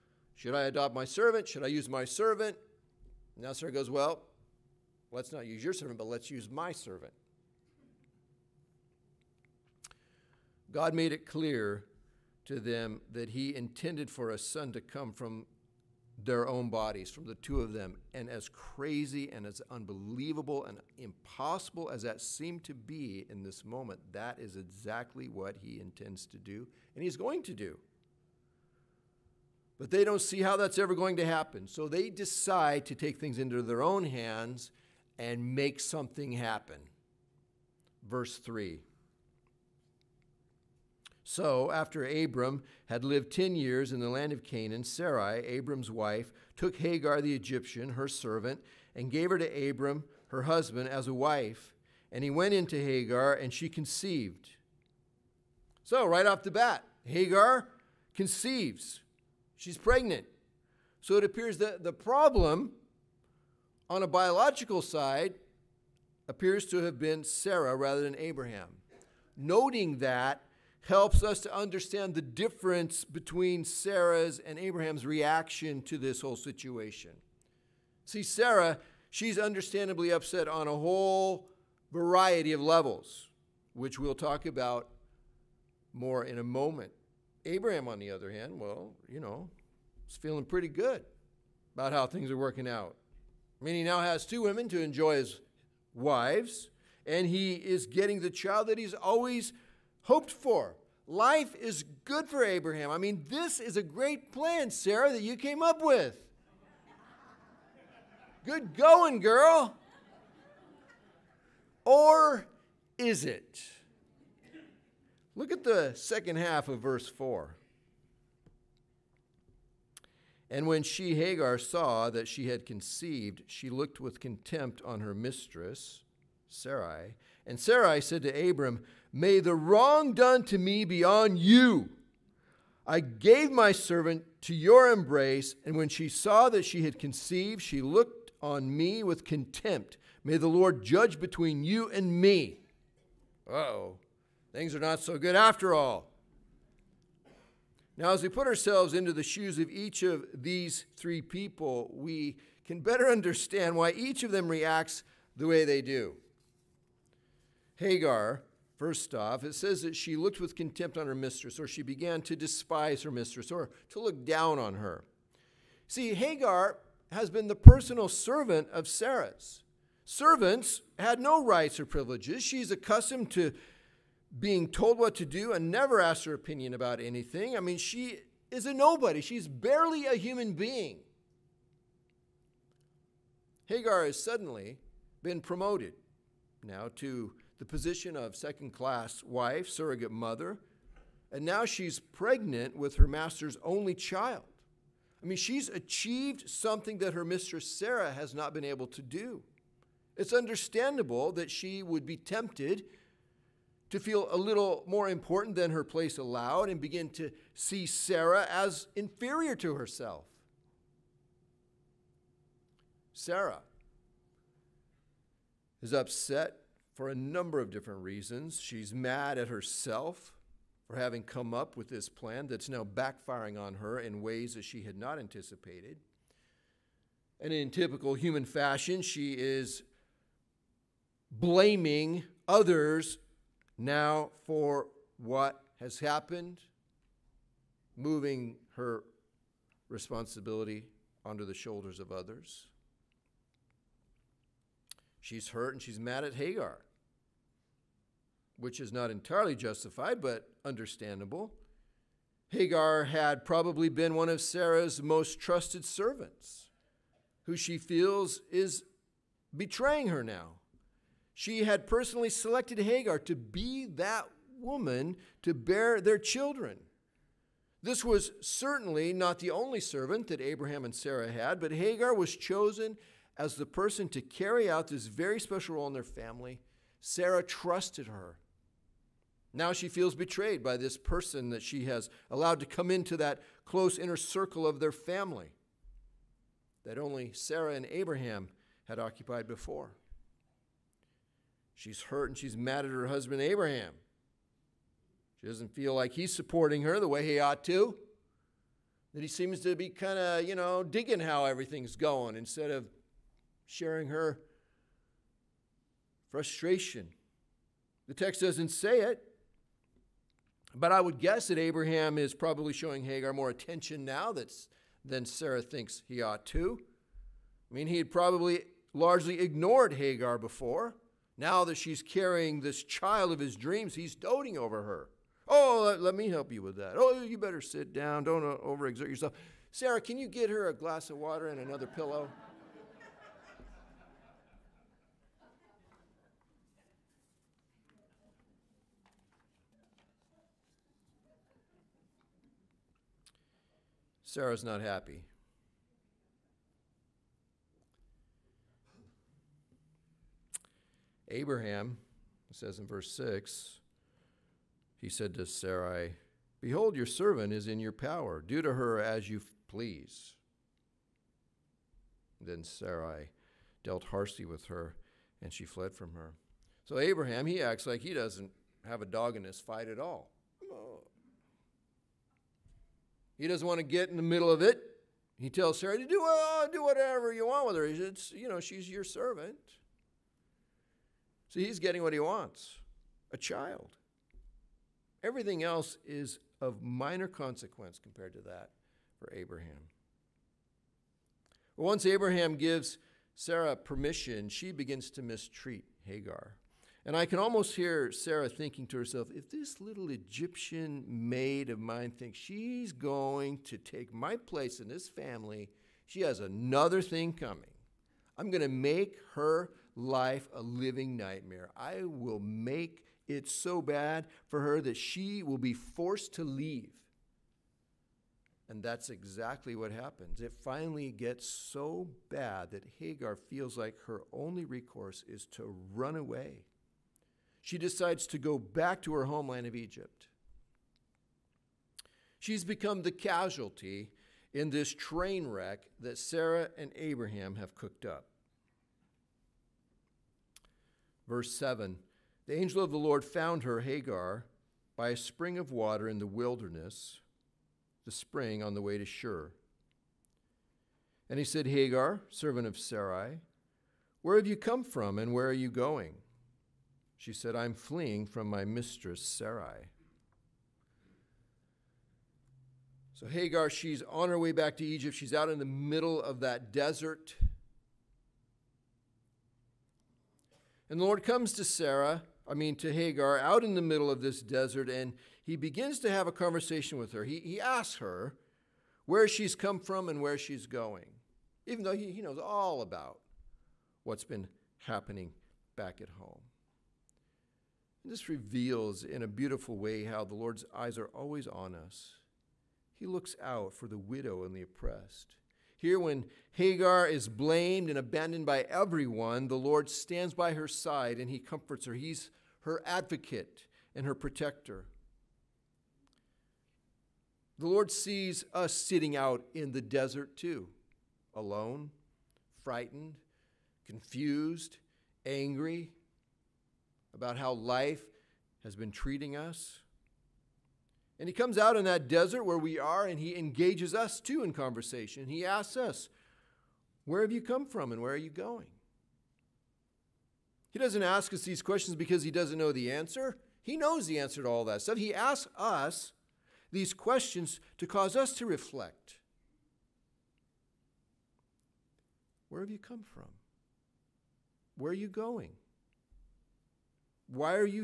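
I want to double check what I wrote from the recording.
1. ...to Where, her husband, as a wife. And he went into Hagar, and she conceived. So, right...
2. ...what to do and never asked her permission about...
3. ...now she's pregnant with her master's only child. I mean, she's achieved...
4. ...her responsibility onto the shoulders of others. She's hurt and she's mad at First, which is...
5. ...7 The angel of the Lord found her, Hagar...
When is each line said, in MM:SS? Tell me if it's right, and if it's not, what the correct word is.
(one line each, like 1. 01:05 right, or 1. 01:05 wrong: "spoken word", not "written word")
1. 00:49 wrong: "Abram", not "Where"
2. 02:54 wrong: "opinion", not "permission"
3. 03:11 right
4. 03:58 wrong: "Hagar", not "First"
5. 07:21 right.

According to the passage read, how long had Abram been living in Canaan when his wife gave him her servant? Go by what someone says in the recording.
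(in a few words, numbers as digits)
10 years.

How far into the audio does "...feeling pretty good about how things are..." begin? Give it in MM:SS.
01:30.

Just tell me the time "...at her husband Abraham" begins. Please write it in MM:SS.
04:52.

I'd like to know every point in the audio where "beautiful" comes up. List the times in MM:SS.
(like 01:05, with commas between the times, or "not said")
08:09.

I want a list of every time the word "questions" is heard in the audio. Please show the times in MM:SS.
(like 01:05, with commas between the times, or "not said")
08:51, 08:56.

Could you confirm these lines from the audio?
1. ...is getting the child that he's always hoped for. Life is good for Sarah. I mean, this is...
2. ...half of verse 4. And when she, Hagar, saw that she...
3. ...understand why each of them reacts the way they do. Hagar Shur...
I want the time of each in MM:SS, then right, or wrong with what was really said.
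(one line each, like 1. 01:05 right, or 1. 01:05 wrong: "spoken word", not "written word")
1. 01:37 wrong: "Abraham", not "Sarah"
2. 01:56 right
3. 02:33 wrong: "First", not "Shur".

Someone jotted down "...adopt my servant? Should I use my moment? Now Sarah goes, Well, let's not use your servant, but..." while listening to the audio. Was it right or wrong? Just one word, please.
wrong.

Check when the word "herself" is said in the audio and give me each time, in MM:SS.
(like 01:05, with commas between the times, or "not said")
03:29, 03:39, 06:38.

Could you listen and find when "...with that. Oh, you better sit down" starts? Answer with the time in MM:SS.
05:26.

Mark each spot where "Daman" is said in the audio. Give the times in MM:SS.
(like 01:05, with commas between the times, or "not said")
not said.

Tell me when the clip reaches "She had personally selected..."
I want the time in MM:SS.
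04:21.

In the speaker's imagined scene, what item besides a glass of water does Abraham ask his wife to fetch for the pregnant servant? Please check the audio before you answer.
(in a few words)
Another pillow.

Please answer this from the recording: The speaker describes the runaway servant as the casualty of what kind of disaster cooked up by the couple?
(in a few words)
Train wreck.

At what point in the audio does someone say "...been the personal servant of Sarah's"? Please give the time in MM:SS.
02:47.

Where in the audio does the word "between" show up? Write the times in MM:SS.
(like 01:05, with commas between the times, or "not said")
01:13, 02:21.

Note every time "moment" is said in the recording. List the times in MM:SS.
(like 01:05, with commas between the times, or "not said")
00:23, 01:26.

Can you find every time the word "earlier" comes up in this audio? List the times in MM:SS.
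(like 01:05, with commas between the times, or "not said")
not said.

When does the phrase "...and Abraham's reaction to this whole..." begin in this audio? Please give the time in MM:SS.
01:14.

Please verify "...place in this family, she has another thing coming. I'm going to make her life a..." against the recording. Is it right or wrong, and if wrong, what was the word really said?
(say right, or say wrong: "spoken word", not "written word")
right.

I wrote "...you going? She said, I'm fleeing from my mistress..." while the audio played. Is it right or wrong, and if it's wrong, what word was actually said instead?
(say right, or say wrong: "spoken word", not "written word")
right.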